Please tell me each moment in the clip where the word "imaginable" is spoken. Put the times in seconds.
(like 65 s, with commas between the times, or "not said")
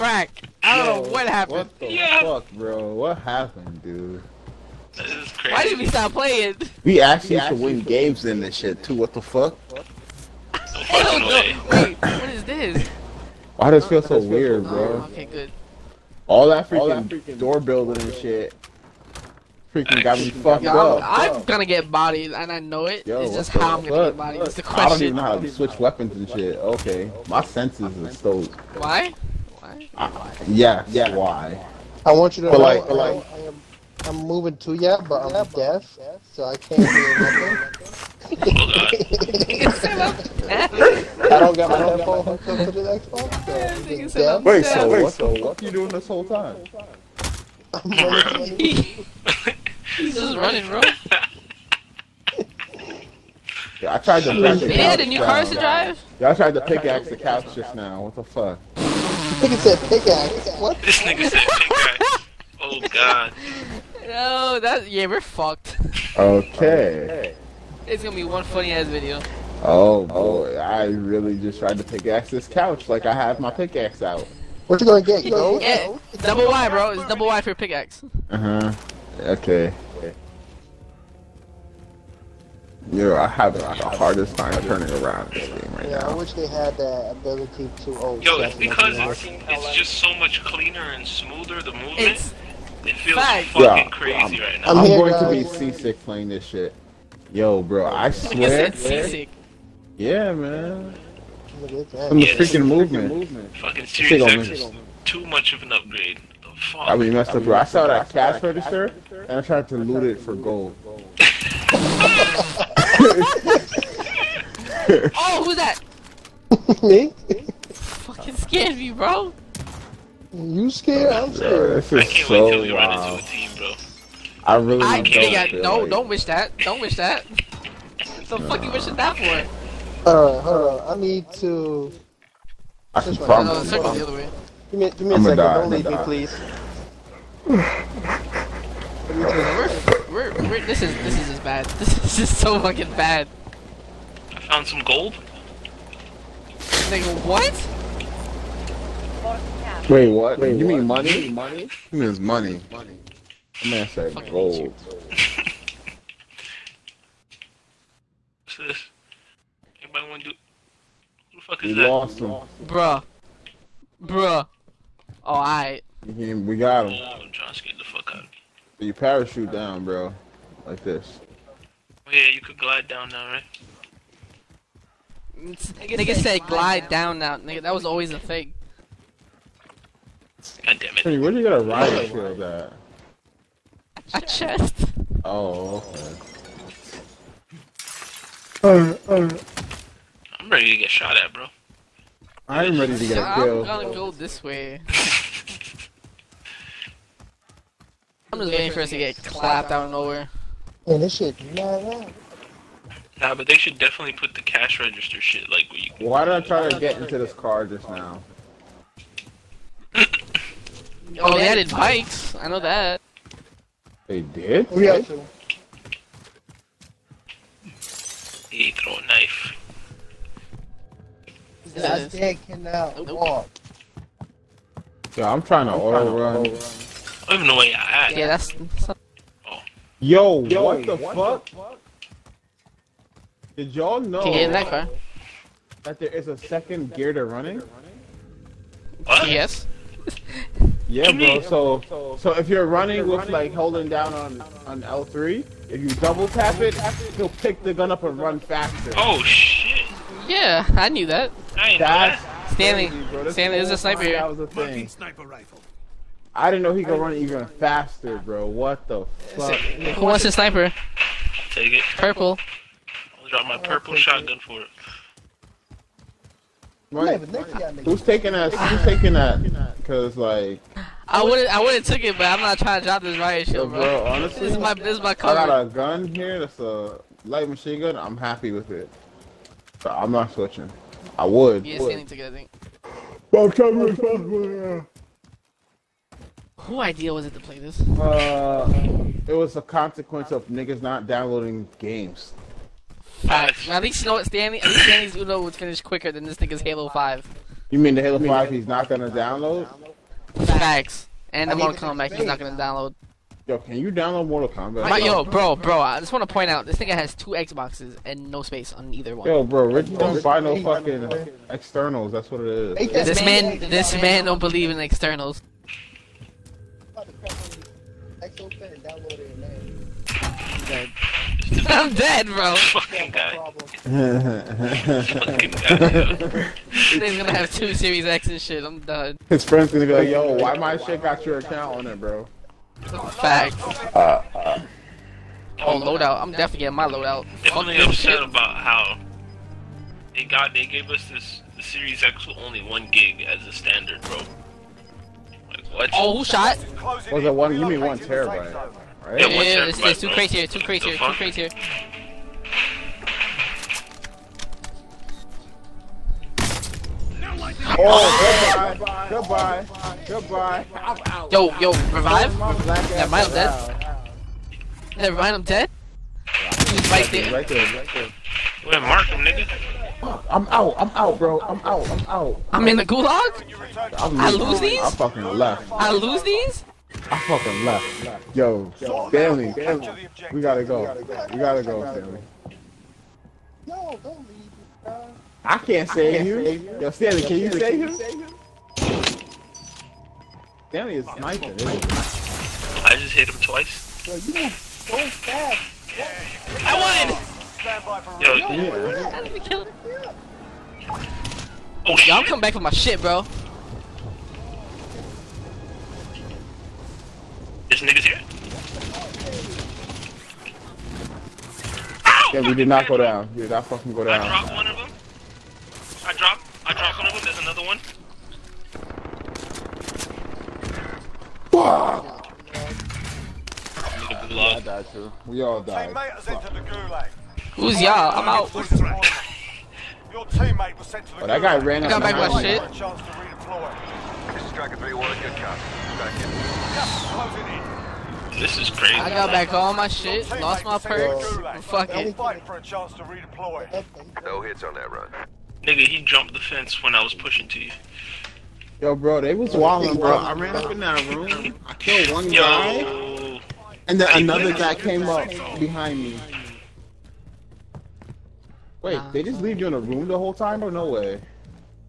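not said.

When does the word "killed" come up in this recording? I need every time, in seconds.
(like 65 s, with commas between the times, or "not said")
193 s, 451 s.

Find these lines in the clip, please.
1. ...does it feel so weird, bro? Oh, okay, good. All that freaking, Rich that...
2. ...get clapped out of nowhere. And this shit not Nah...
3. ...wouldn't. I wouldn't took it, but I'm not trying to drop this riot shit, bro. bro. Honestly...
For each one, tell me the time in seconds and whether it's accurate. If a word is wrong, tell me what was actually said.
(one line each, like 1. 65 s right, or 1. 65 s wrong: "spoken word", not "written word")
1. 13 s wrong: "All", not "Rich"
2. 198 s right
3. 271 s right.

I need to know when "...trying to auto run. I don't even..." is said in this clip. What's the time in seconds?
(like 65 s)
225 s.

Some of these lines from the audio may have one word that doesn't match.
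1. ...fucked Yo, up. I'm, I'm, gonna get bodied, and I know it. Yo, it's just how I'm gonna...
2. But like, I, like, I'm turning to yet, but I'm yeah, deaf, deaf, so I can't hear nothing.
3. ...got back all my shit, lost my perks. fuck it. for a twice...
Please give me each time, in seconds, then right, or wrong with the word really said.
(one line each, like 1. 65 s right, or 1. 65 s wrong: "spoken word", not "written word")
1. 20 s right
2. 32 s wrong: "moving", not "turning"
3. 439 s wrong: "chance", not "twice".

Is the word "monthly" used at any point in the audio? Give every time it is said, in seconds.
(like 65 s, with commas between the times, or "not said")
not said.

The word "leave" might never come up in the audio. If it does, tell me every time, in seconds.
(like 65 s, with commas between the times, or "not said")
135 s, 384 s, 459 s.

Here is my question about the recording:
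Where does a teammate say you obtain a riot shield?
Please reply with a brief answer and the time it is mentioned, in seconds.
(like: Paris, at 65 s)
A chest, at 184 s.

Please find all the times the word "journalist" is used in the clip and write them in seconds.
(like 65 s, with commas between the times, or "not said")
not said.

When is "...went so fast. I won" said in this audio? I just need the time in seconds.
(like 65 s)
394 s.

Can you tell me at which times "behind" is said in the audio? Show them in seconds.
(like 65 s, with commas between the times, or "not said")
455 s.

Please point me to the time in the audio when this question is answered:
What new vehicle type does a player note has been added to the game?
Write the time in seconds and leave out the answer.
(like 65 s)
211 s.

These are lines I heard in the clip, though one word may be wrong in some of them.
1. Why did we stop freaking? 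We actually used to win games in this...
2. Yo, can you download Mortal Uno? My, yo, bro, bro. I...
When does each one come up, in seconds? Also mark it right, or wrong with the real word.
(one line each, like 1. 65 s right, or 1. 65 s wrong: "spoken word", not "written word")
1. 5 s wrong: "playing", not "freaking"
2. 303 s wrong: "Kombat", not "Uno".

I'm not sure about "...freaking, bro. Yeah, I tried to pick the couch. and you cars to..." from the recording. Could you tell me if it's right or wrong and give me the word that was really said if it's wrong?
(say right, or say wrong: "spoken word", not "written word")
wrong: "running", not "freaking".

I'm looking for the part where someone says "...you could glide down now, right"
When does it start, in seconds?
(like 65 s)
172 s.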